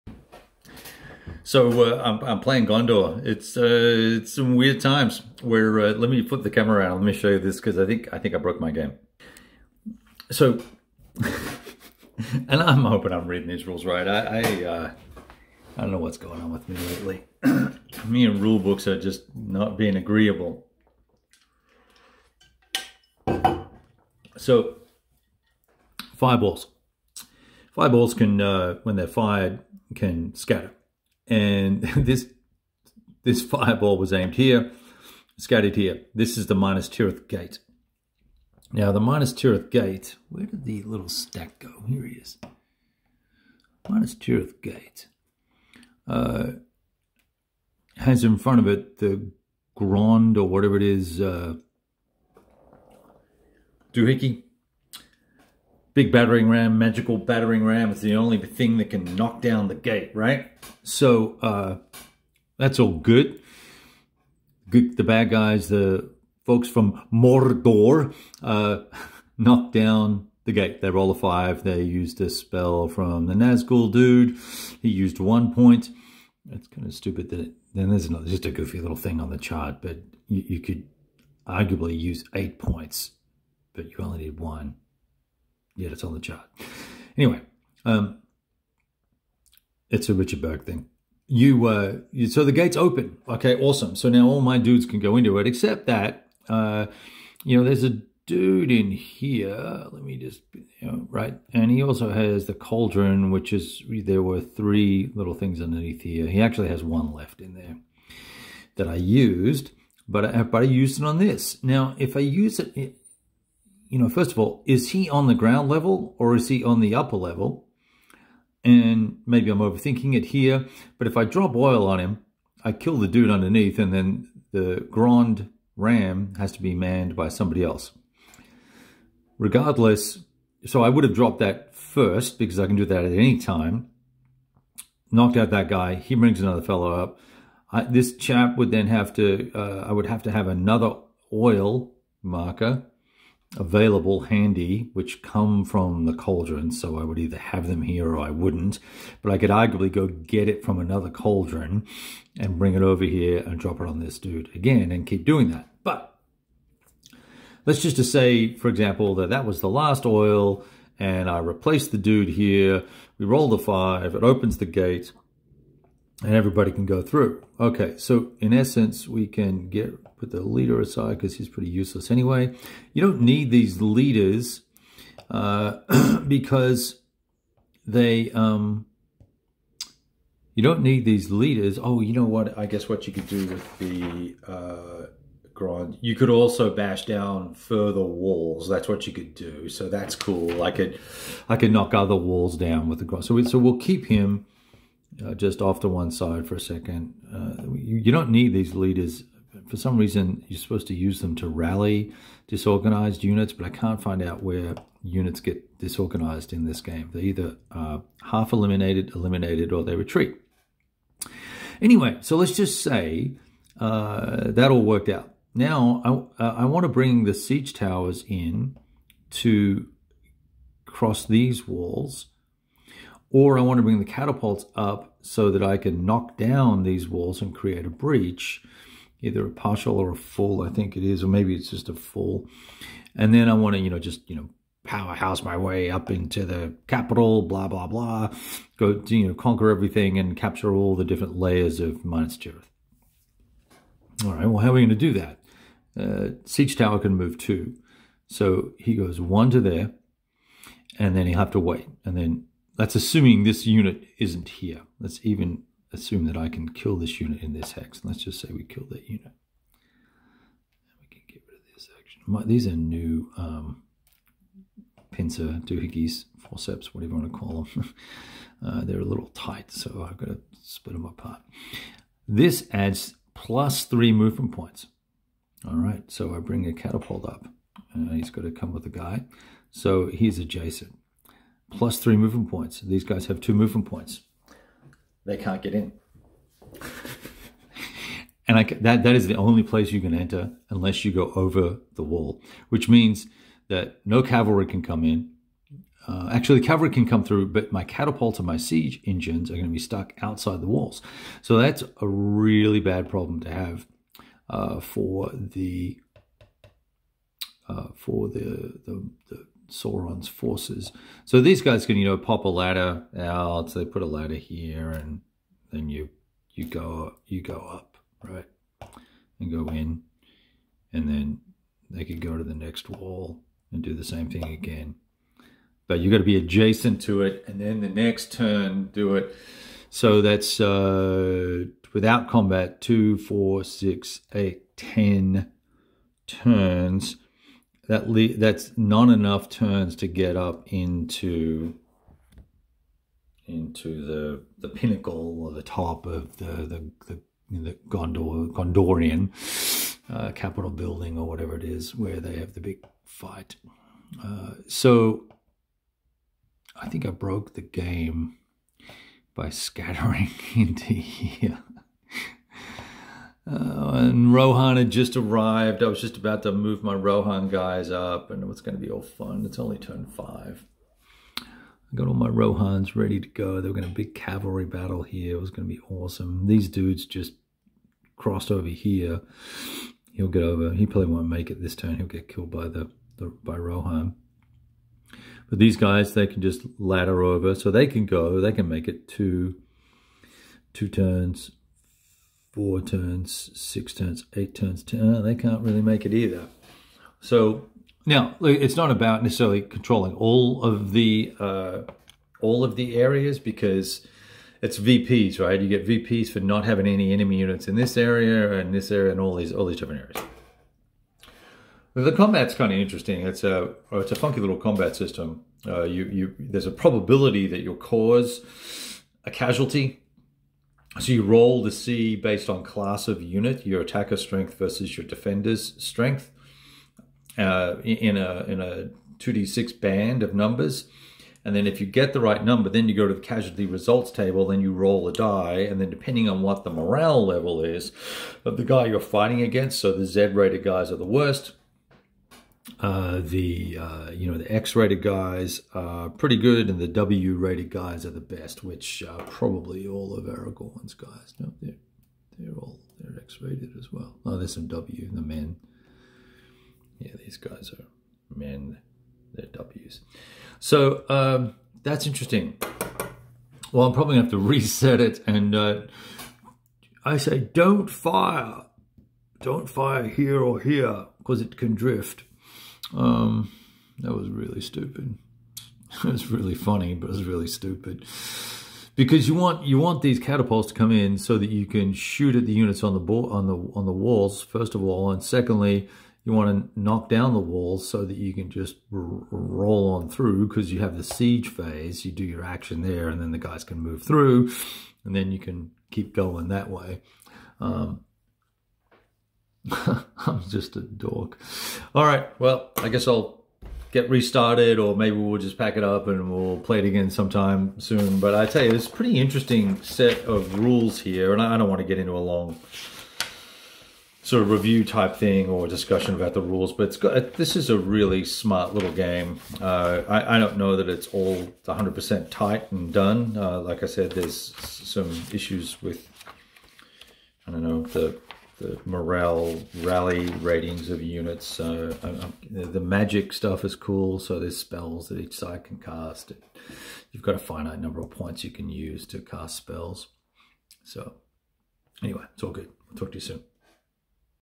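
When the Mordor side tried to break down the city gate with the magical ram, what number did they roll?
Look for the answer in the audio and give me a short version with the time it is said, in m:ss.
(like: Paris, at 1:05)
5, at 1:10.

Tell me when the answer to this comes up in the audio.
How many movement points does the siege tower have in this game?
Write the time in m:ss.
4:06.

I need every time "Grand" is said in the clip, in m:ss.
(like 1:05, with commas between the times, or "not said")
3:05, 3:13.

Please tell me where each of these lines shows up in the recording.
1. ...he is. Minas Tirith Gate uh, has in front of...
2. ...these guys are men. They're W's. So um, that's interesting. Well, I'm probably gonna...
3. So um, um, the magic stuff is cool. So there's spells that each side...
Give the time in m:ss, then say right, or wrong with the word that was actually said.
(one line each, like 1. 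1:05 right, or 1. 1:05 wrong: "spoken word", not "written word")
1. 0:42 right
2. 7:37 right
3. 8:51 right.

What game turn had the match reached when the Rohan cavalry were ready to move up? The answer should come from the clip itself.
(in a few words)
5.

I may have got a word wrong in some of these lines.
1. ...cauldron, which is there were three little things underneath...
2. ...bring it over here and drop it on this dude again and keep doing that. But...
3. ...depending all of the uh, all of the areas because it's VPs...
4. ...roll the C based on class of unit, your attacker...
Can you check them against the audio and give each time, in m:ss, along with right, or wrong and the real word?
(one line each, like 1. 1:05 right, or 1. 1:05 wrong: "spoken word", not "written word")
1. 1:42 right
2. 2:32 right
3. 6:39 wrong: "controlling", not "depending"
4. 7:01 right.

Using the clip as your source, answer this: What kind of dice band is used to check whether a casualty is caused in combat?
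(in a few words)
2d6.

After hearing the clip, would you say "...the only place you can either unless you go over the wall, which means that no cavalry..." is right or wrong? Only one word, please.
wrong.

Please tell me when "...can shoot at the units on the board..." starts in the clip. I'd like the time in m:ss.
8:01.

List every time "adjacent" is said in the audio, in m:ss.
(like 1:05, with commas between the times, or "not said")
4:40, 5:26.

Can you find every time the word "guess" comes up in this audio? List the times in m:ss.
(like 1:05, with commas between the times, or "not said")
3:02, 8:22.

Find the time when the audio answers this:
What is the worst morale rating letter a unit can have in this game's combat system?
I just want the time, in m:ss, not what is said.
7:20.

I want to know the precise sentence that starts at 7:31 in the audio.
No, they're they're all they're X-rated as well.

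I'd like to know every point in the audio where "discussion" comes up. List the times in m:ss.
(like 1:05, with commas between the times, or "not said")
8:35.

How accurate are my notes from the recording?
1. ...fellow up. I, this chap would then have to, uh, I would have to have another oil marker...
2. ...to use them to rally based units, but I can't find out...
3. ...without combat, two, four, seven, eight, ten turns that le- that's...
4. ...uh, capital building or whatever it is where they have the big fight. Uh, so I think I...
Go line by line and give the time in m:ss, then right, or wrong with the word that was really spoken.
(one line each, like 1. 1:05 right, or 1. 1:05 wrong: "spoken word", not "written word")
1. 2:16 right
2. 3:20 wrong: "disorganized", not "based"
3. 5:31 wrong: "six", not "seven"
4. 5:50 right.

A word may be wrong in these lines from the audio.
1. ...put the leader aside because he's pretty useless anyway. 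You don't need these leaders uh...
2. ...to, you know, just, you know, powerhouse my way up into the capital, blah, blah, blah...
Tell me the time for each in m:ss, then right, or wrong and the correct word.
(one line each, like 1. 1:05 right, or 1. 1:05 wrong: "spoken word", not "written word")
1. 2:50 right
2. 3:53 right.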